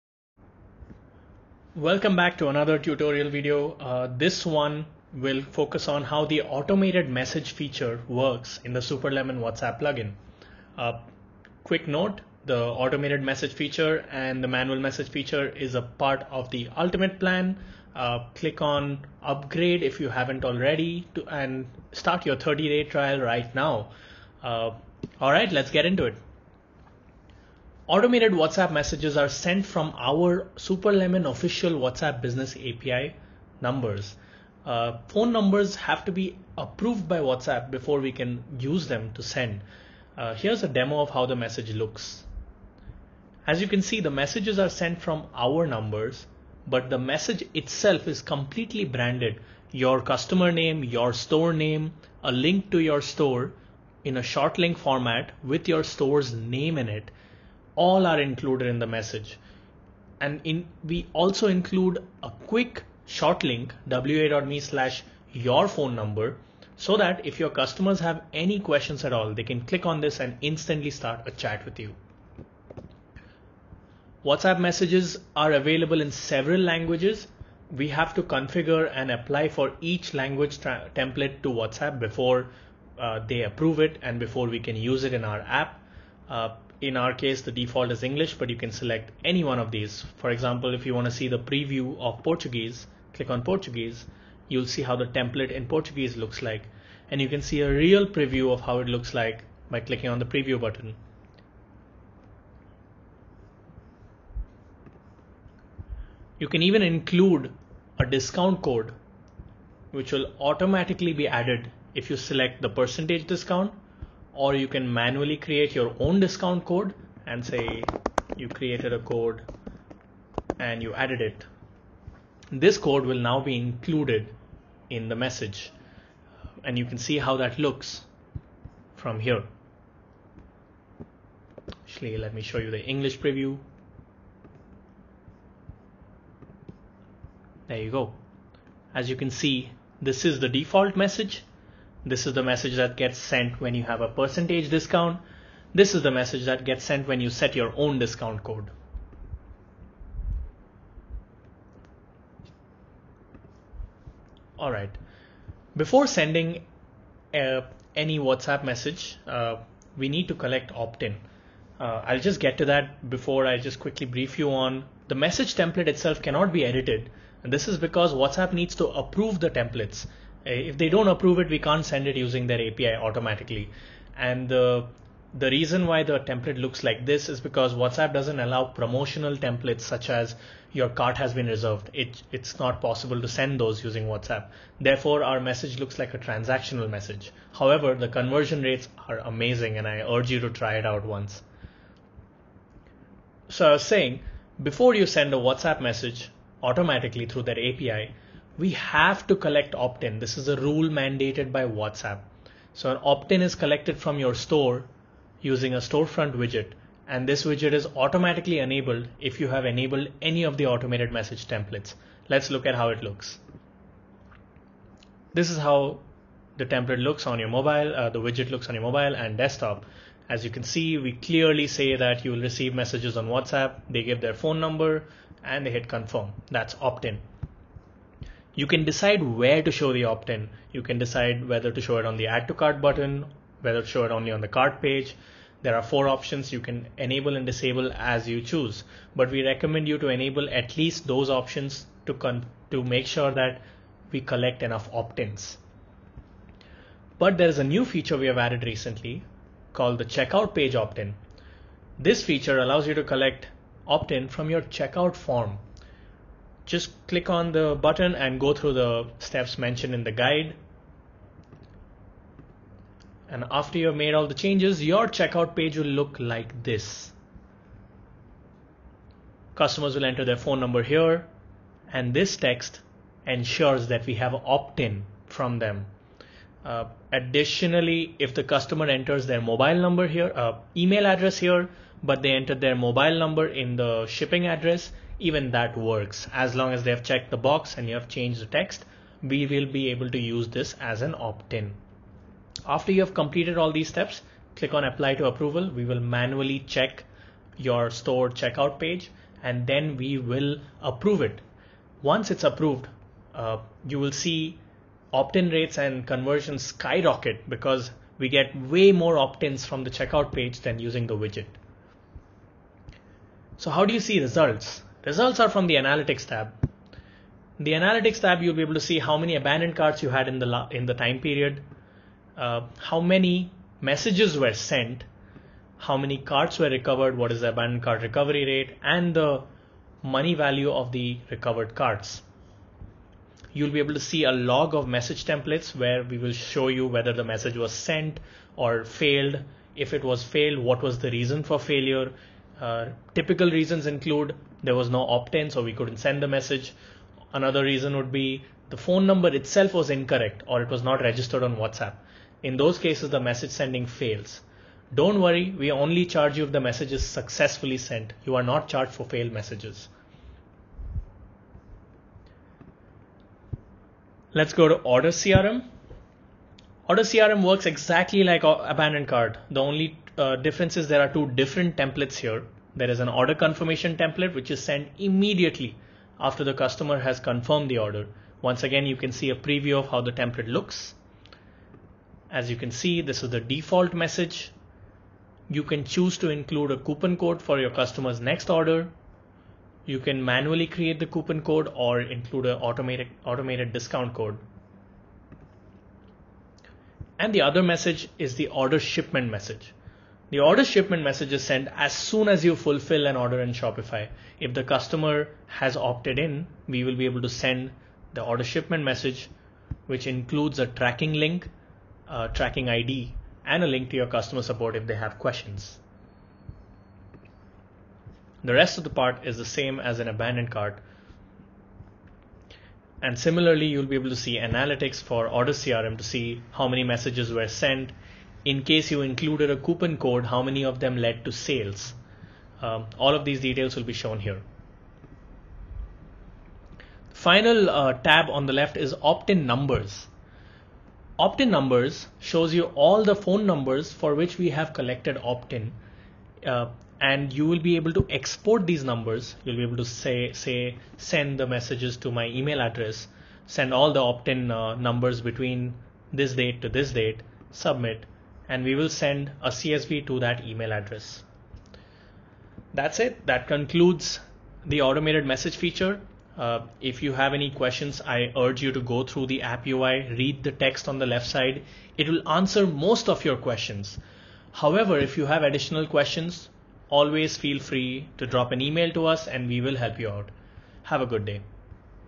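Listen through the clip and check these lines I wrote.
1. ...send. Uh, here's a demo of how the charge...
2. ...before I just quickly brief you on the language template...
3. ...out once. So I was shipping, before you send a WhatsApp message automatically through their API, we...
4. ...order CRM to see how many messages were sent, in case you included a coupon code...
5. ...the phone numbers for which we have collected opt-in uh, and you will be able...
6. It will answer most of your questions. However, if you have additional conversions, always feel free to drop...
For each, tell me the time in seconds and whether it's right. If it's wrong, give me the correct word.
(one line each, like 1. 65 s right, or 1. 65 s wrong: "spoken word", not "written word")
1. 39 s wrong: "message", not "charge"
2. 163 s wrong: "message", not "language"
3. 190 s wrong: "saying", not "shipping"
4. 425 s right
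5. 443 s right
6. 471 s wrong: "questions", not "conversions".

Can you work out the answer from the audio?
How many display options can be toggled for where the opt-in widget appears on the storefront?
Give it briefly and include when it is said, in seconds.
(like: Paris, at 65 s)
4, at 235 s.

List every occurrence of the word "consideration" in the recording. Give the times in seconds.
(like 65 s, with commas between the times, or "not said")
not said.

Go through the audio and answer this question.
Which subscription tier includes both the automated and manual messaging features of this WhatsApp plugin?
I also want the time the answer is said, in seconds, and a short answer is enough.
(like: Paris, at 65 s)
ultimate plan, at 16 s.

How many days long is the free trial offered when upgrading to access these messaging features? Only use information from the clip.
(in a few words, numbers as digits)
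30.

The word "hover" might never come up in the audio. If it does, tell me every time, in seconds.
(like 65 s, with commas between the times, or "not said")
not said.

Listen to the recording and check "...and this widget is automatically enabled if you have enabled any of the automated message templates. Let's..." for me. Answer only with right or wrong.
right.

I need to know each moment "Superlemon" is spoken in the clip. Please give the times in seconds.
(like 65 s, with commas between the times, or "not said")
8 s, 30 s.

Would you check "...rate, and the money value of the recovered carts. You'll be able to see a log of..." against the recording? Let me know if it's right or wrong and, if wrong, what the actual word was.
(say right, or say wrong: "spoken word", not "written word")
right.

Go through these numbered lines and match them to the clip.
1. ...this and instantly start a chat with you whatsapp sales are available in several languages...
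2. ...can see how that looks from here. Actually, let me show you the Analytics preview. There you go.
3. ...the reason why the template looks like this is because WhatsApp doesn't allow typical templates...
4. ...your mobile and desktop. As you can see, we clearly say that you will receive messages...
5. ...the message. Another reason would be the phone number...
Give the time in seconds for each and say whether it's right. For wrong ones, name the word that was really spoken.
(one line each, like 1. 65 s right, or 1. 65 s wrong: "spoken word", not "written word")
1. 70 s wrong: "messages", not "sales"
2. 126 s wrong: "English", not "Analytics"
3. 175 s wrong: "promotional", not "typical"
4. 218 s right
5. 346 s right.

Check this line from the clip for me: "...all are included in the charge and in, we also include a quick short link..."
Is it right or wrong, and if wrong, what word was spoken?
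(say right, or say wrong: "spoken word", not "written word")
wrong: "message", not "charge".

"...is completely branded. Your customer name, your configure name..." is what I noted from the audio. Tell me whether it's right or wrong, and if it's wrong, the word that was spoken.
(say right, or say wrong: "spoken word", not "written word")
wrong: "store", not "configure".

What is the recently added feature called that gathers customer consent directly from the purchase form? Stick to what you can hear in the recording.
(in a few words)
checkout page opt-in.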